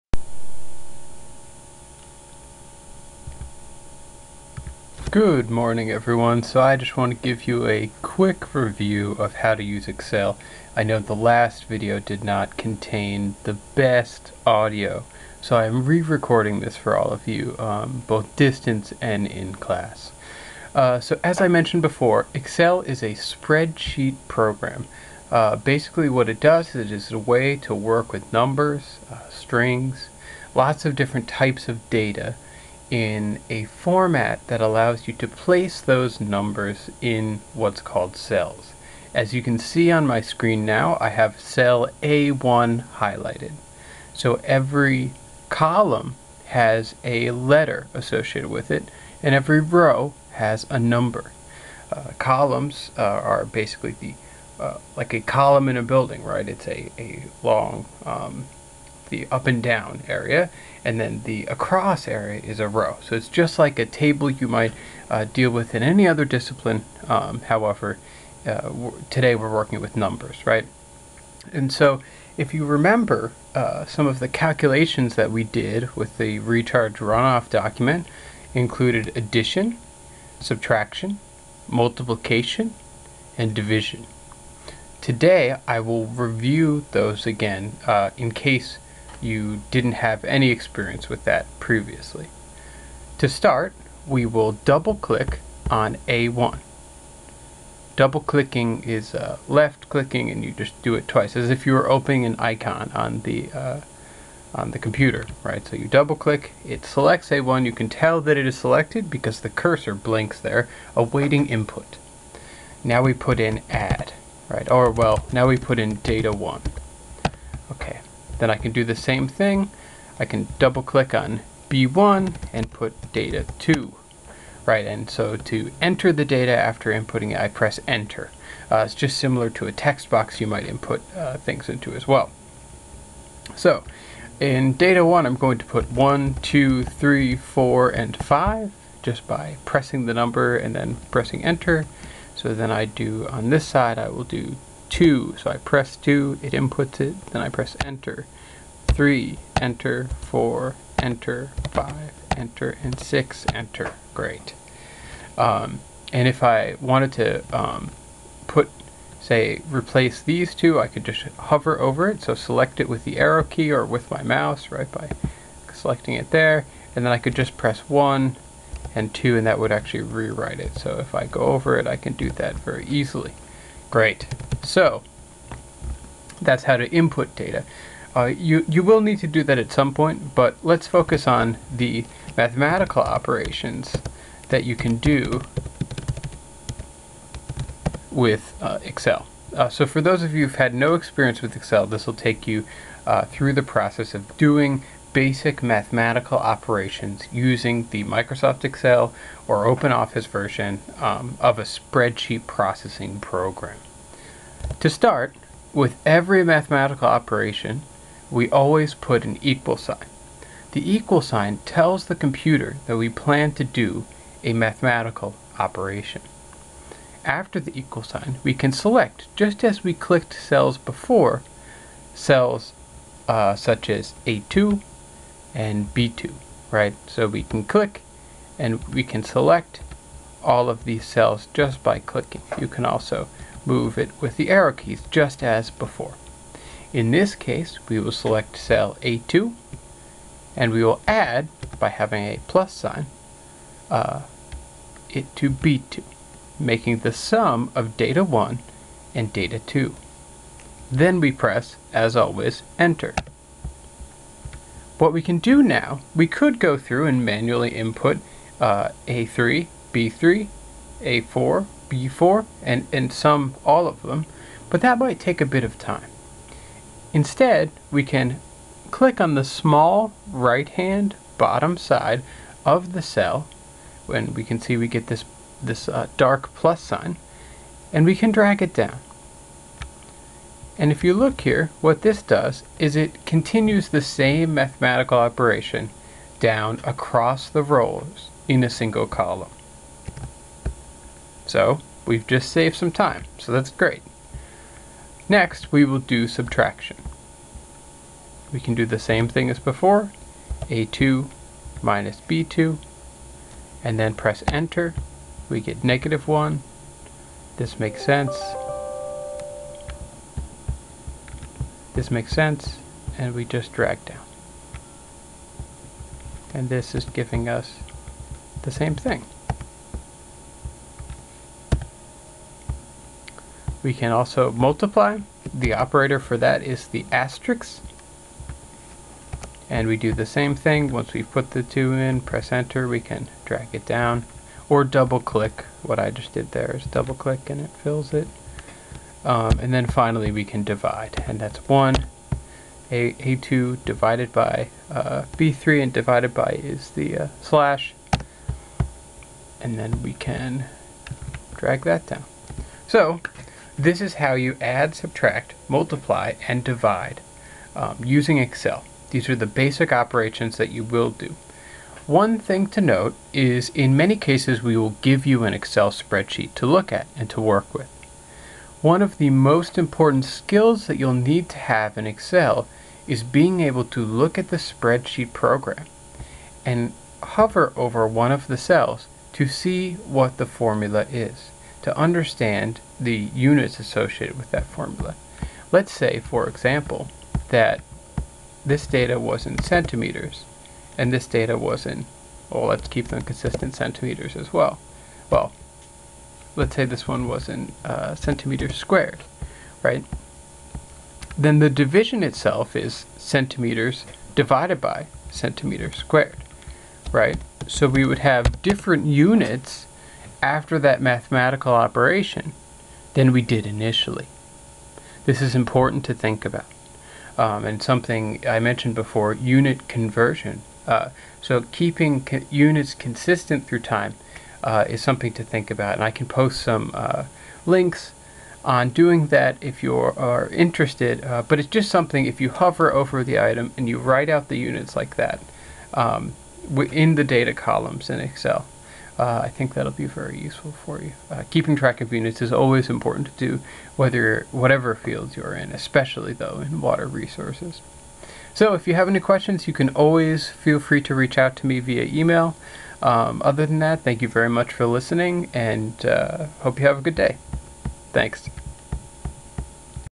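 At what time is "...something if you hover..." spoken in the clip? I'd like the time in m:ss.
7:11.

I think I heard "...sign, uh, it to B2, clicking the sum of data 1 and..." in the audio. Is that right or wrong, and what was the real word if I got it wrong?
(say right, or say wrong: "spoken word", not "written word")
wrong: "making", not "clicking".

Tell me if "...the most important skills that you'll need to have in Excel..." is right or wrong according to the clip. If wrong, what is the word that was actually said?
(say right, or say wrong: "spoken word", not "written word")
right.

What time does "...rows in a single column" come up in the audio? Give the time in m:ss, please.
4:47.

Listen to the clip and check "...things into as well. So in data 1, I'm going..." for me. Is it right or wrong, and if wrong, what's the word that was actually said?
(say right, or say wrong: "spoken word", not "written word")
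right.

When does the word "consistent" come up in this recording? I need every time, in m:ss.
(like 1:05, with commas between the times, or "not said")
6:33, 7:02.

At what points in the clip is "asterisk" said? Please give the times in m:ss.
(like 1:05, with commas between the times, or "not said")
5:27.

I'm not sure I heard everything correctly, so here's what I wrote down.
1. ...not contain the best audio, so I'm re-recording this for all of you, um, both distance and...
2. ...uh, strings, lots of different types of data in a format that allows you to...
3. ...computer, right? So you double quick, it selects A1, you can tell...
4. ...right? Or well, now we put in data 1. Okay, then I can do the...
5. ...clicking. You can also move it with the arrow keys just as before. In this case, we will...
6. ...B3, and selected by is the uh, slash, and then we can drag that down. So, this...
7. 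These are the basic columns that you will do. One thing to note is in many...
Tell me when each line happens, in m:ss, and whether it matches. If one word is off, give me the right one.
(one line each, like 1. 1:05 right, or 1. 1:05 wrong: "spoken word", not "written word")
1. 0:12 right
2. 0:29 right
3. 1:44 wrong: "click", not "quick"
4. 1:54 right
5. 3:51 right
6. 5:45 wrong: "divided", not "selected"
7. 5:59 wrong: "operations", not "columns".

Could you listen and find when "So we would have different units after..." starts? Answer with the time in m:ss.
6:47.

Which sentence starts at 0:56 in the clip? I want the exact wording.
It's a, a long um, the up and down area, and then the across area is a row.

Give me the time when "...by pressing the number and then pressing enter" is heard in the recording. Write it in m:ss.
2:19.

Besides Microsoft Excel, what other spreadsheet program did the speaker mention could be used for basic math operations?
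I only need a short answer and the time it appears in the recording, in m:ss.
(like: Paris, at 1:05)
OpenOffice, at 3:19.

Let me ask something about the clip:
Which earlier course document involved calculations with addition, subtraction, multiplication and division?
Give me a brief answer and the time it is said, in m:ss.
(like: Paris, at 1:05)
Recharge runoff document, at 1:16.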